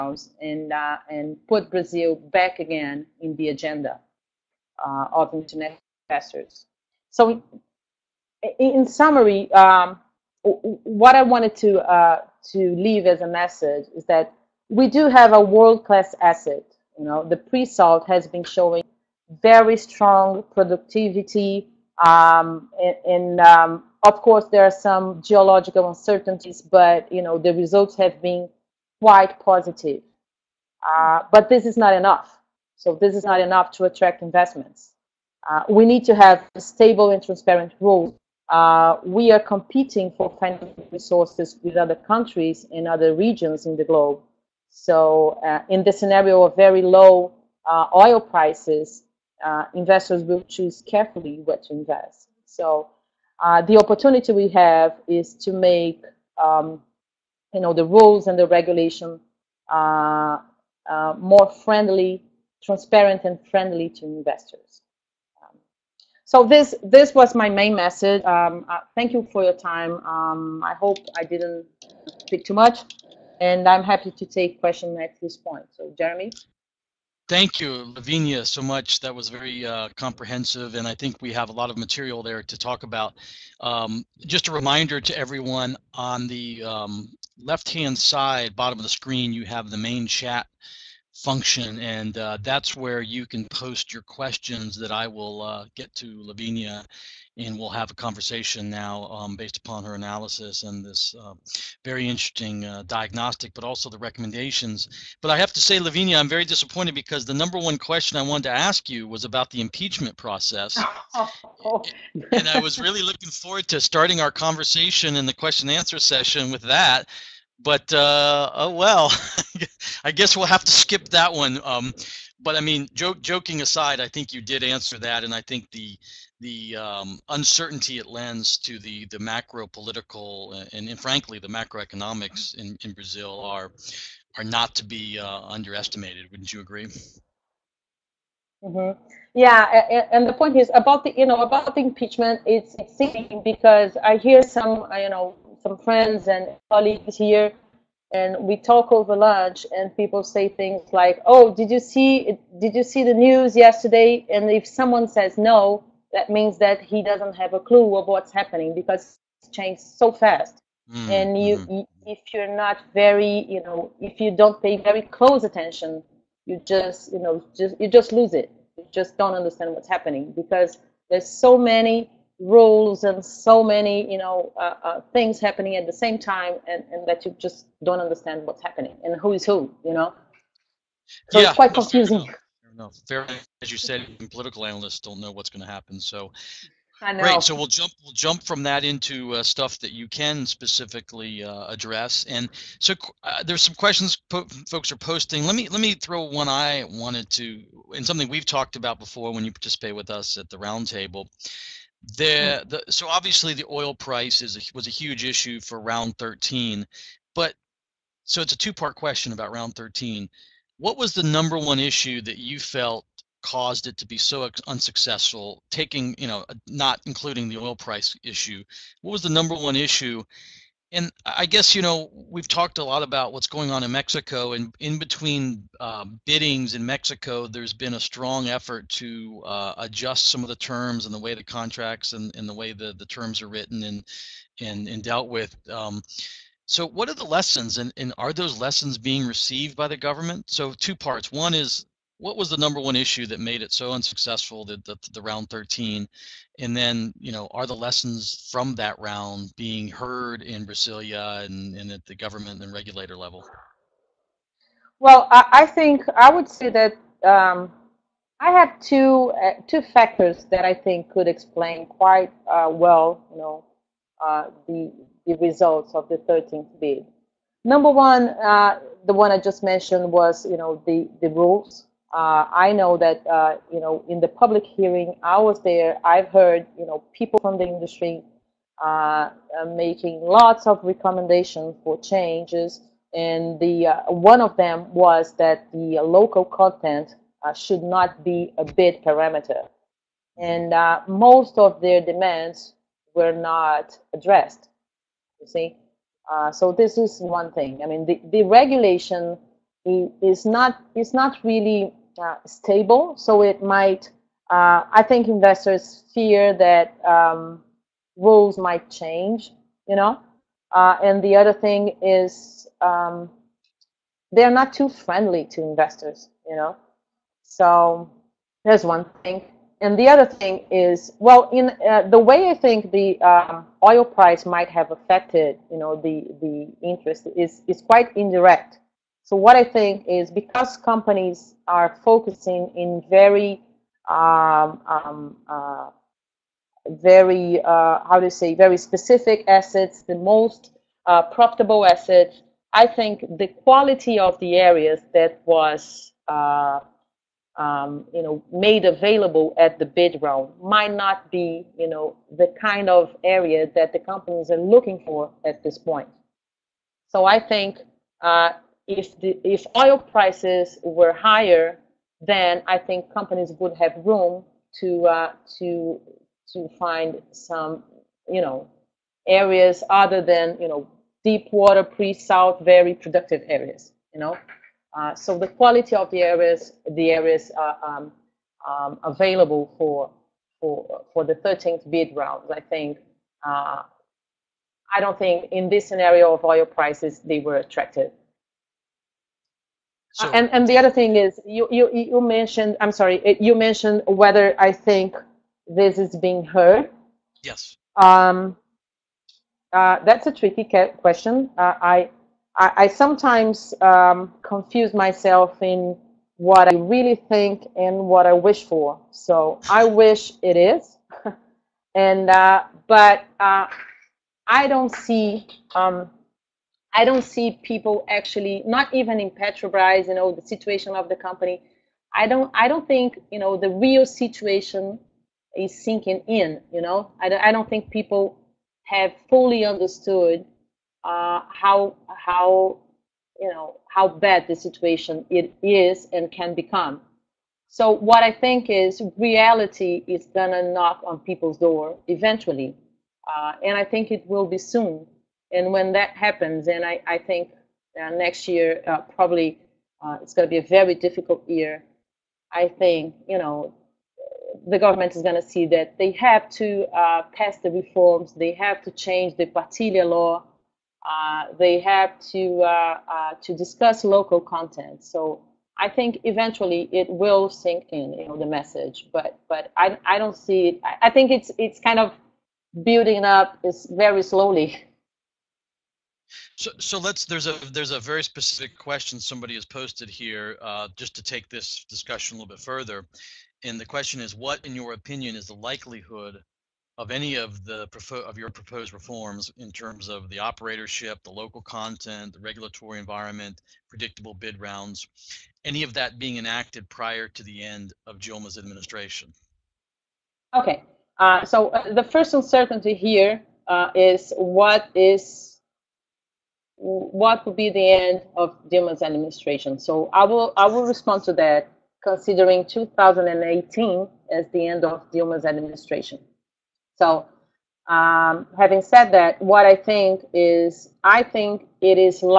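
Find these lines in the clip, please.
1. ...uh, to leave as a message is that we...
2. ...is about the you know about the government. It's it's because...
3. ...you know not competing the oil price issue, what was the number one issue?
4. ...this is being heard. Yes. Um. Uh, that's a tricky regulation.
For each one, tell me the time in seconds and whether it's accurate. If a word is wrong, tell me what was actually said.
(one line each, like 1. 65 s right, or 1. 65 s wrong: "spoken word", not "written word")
1. 11 s right
2. 140 s wrong: "impeachment", not "government"
3. 216 s wrong: "including", not "competing"
4. 395 s wrong: "question", not "regulation".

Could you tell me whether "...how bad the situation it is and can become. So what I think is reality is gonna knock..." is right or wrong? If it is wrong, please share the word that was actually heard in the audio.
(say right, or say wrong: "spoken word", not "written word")
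right.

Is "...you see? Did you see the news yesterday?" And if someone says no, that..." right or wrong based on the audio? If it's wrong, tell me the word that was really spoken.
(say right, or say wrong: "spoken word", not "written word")
right.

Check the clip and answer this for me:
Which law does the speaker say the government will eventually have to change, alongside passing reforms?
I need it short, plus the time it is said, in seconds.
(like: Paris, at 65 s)
Partilha law, at 459 s.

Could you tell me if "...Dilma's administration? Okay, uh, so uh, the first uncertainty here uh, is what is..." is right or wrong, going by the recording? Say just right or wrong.
right.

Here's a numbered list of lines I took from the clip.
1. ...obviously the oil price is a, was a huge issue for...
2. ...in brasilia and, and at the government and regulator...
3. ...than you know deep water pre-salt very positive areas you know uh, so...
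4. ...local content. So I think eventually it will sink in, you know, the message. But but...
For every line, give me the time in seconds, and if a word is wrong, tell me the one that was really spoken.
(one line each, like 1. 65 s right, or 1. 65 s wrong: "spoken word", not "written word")
1. 203 s right
2. 250 s right
3. 370 s wrong: "productive", not "positive"
4. 464 s right.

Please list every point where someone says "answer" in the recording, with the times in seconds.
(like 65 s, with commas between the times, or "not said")
115 s, 124 s.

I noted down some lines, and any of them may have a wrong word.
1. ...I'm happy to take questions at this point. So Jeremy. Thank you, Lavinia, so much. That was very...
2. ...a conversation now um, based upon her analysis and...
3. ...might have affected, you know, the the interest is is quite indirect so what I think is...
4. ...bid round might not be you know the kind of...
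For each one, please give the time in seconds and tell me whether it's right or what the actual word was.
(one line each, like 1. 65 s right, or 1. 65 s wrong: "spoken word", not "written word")
1. 73 s right
2. 97 s right
3. 324 s right
4. 349 s right.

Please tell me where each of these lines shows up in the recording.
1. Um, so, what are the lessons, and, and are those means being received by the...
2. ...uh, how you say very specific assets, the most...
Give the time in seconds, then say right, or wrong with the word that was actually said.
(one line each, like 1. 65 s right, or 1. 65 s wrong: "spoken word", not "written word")
1. 235 s wrong: "lessons", not "means"
2. 337 s right.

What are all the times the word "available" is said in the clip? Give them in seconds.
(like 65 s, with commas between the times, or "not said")
348 s, 379 s.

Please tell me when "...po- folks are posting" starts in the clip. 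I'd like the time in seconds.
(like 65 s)
194 s.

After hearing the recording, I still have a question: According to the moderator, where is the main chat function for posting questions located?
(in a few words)
left hand side, bottom.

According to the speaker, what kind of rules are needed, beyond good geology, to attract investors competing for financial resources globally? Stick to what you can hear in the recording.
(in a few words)
stable and transparent.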